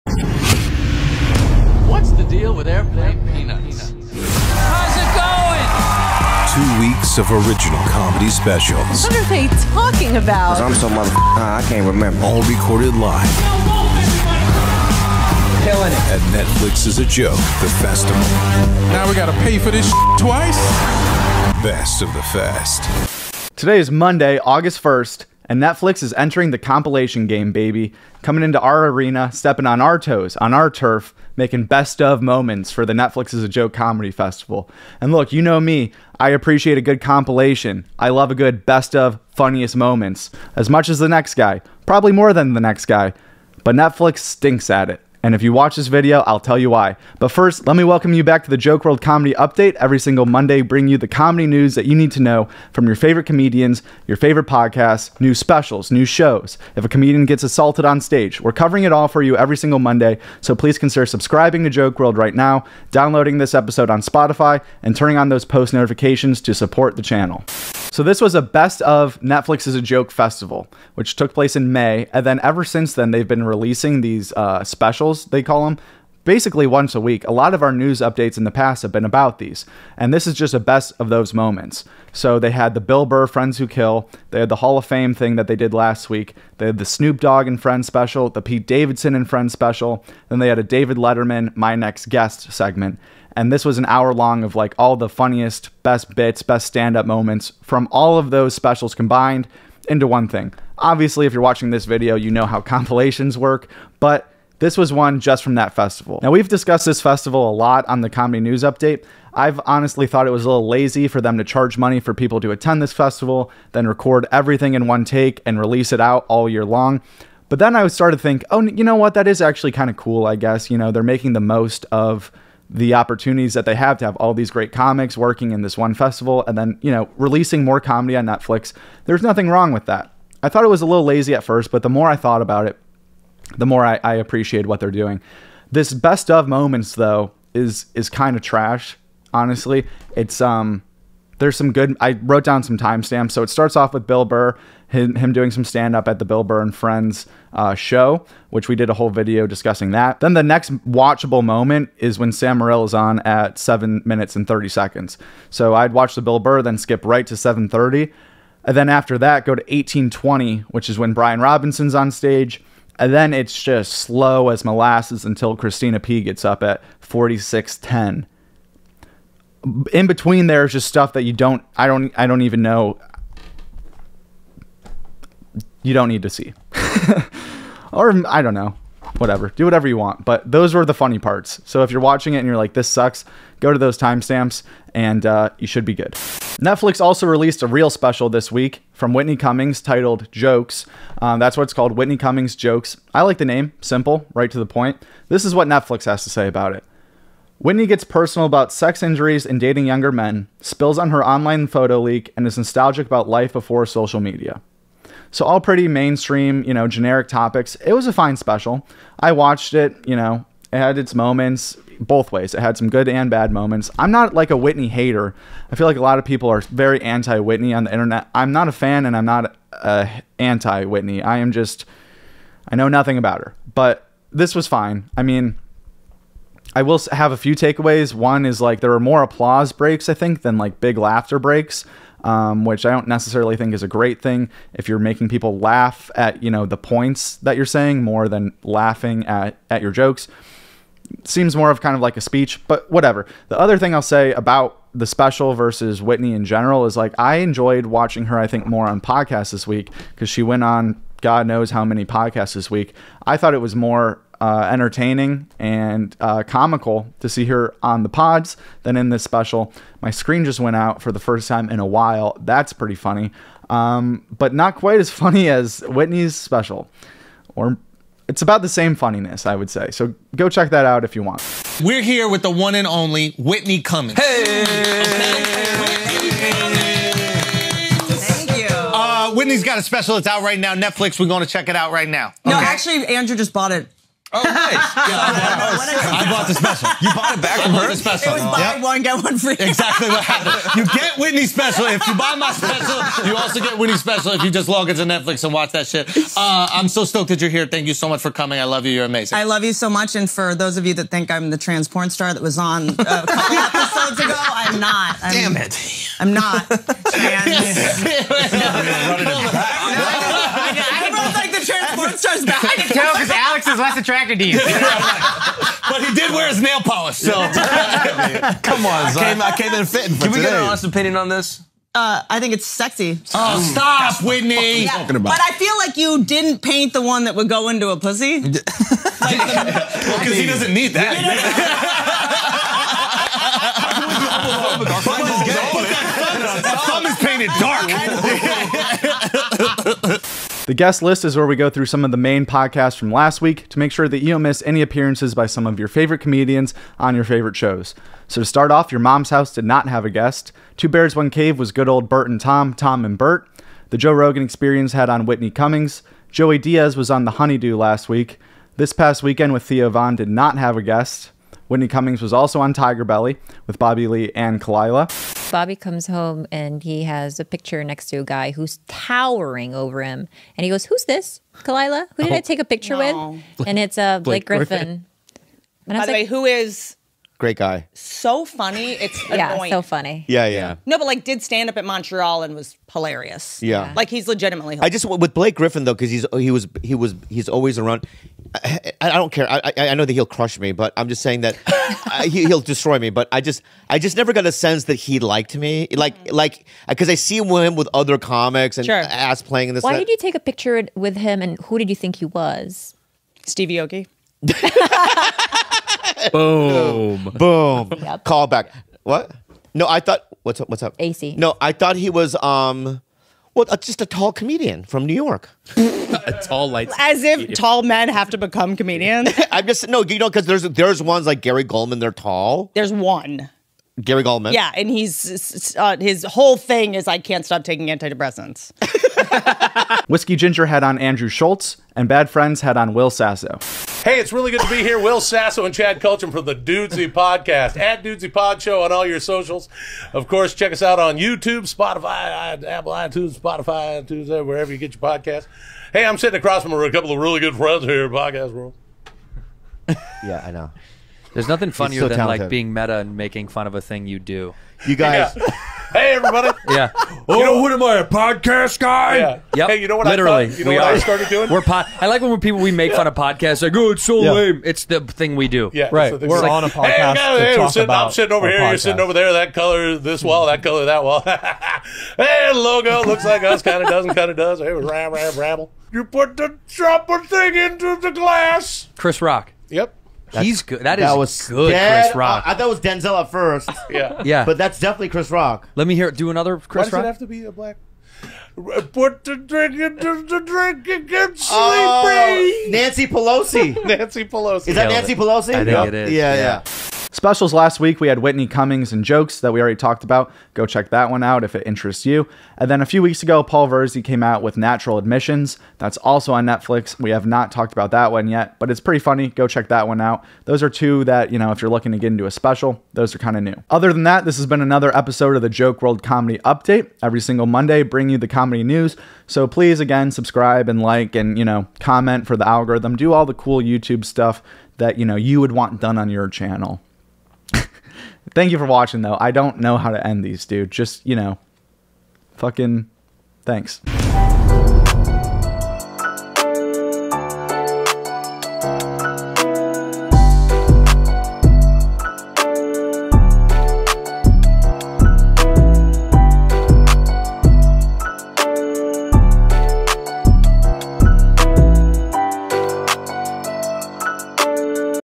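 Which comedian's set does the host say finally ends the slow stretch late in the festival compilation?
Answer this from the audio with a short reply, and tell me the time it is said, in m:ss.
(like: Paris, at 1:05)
Christina P, at 2:45.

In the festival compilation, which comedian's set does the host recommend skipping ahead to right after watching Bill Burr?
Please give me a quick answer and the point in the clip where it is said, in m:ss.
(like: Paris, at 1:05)
Sam Morril, at 2:32.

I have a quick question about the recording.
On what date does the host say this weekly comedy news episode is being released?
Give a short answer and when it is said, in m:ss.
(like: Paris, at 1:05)
Monday, August 1st, at 0:23.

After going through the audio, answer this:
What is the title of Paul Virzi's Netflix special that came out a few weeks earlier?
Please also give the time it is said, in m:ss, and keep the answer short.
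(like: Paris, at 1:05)
Nocturnal Admissions, at 8:24.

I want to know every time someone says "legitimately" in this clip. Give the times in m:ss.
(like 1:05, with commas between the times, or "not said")
6:24.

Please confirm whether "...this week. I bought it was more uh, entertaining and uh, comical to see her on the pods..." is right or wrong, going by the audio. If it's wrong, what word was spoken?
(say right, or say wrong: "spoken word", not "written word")
wrong: "thought", not "bought".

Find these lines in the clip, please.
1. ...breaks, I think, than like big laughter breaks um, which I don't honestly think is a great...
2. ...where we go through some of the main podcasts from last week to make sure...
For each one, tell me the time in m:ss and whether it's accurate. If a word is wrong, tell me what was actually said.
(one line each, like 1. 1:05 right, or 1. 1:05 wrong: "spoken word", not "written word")
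1. 3:49 wrong: "necessarily", not "honestly"
2. 5:41 right.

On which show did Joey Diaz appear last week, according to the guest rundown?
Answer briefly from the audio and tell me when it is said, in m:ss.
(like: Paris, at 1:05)
The Honeydew, at 5:57.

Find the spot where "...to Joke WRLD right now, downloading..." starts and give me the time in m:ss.
1:01.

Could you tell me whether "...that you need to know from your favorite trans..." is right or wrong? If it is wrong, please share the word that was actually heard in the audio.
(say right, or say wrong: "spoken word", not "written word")
wrong: "comedians", not "trans".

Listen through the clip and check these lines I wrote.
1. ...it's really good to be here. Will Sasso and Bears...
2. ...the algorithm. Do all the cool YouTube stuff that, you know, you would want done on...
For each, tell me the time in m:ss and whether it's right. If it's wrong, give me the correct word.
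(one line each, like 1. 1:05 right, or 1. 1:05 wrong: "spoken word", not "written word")
1. 7:14 wrong: "Chad", not "Bears"
2. 8:42 right.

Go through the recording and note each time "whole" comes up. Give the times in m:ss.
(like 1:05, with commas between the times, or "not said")
2:28, 7:06.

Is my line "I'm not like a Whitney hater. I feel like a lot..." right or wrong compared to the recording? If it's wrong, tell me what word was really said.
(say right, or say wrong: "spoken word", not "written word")
right.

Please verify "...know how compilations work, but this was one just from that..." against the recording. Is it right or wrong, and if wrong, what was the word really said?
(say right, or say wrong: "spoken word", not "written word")
right.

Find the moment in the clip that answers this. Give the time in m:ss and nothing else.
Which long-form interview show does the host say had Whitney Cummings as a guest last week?
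5:53.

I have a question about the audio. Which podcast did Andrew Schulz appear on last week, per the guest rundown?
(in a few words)
Whiskey Ginger.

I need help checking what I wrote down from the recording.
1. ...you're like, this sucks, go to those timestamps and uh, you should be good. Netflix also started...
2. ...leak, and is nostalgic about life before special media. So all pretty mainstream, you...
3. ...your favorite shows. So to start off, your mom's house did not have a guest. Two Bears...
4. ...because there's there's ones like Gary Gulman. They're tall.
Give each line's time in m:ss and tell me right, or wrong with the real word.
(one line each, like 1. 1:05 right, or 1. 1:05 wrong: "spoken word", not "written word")
1. 3:02 wrong: "released", not "started"
2. 3:22 wrong: "social", not "special"
3. 5:47 right
4. 7:00 right.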